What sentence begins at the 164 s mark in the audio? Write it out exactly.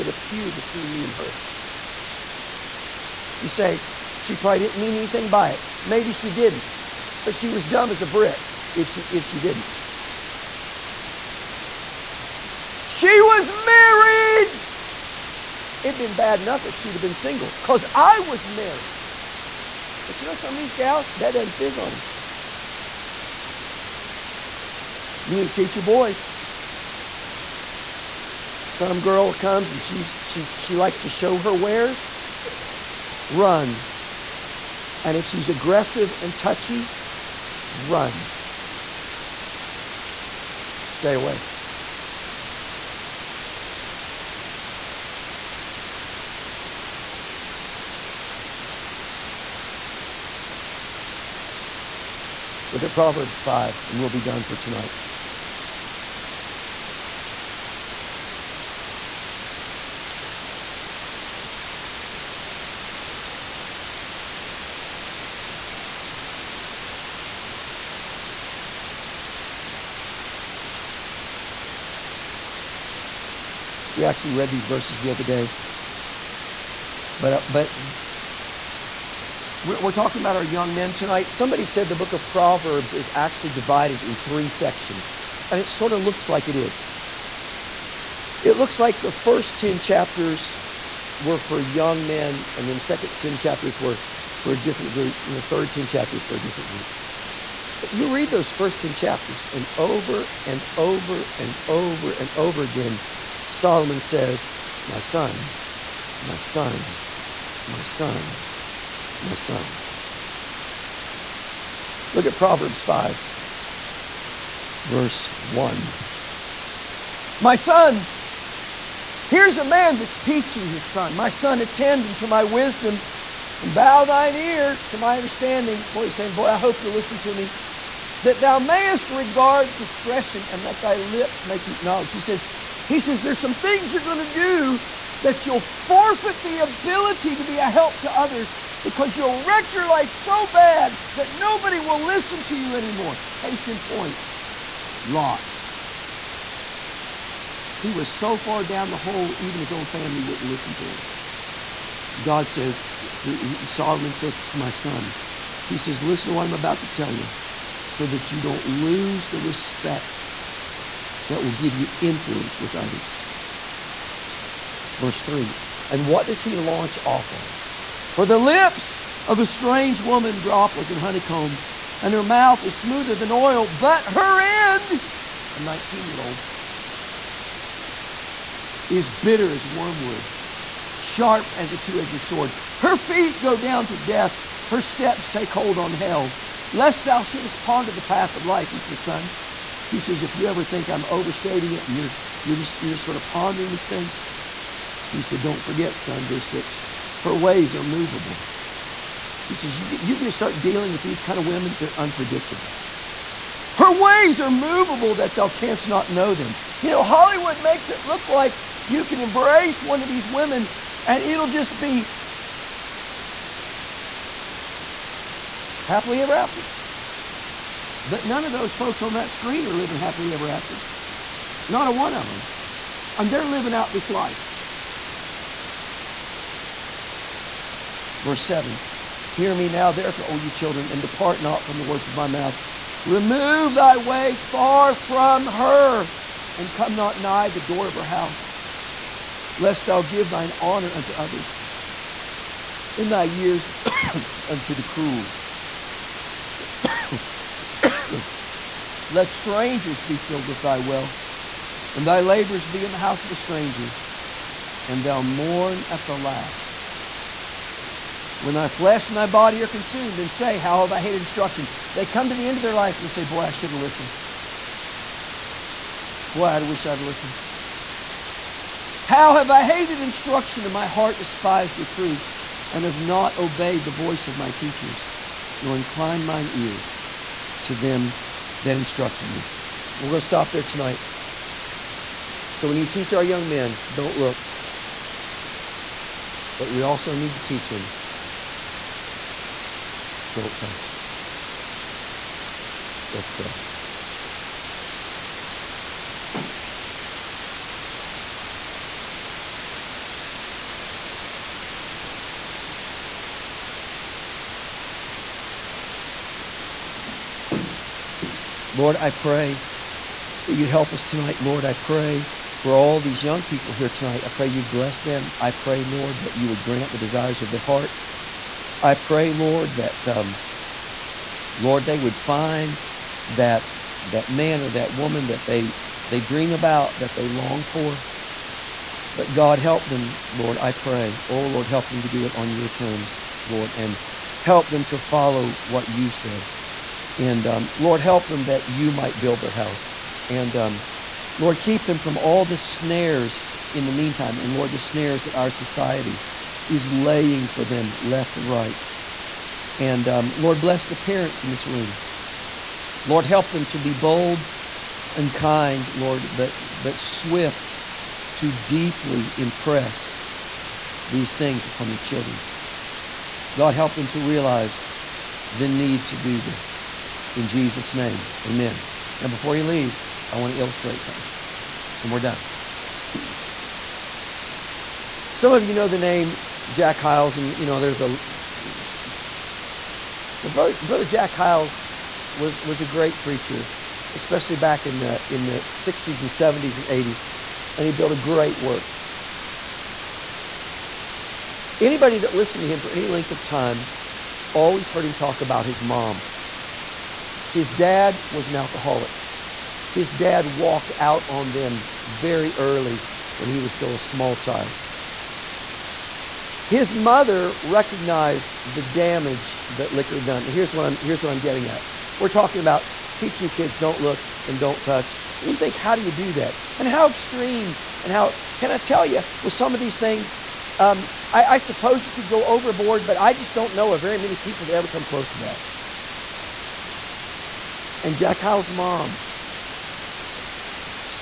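Verse 3 And what does he launch off on?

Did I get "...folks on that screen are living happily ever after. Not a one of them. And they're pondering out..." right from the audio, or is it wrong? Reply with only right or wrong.
wrong.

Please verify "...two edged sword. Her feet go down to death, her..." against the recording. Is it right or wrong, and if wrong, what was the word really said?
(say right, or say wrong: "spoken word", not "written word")
right.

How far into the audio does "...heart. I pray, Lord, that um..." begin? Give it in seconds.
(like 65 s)
317 s.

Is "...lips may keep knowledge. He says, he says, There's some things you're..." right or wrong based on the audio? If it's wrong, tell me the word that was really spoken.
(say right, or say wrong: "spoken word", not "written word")
right.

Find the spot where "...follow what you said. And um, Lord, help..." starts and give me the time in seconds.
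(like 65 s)
334 s.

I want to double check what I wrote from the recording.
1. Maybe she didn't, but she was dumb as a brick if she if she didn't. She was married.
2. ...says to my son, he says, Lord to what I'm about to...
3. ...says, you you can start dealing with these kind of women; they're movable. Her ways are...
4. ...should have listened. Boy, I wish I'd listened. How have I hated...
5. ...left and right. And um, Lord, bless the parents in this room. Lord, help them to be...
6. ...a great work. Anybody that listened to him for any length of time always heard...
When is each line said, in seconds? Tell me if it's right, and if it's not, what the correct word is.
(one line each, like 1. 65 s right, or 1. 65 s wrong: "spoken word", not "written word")
1. 5 s right
2. 154 s wrong: "Listen", not "Lord"
3. 199 s wrong: "unpredictable", not "movable"
4. 263 s right
5. 347 s right
6. 388 s right.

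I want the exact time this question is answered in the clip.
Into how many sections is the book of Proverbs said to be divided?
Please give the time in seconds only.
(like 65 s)
84 s.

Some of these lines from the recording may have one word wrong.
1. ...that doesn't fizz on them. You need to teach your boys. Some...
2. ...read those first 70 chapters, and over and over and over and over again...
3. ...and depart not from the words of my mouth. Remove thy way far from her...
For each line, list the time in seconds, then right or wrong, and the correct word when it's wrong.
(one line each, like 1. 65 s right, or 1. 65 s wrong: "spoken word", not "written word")
1. 21 s right
2. 98 s wrong: "10", not "70"
3. 230 s right.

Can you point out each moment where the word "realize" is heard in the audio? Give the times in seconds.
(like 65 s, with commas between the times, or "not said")
364 s.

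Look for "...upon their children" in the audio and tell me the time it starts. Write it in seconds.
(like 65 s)
361 s.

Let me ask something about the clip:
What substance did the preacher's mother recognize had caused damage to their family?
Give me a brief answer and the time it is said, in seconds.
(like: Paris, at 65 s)
Liquor, at 409 s.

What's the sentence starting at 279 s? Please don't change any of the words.
We're going to stop there tonight.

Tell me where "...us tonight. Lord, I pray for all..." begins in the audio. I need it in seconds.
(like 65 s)
310 s.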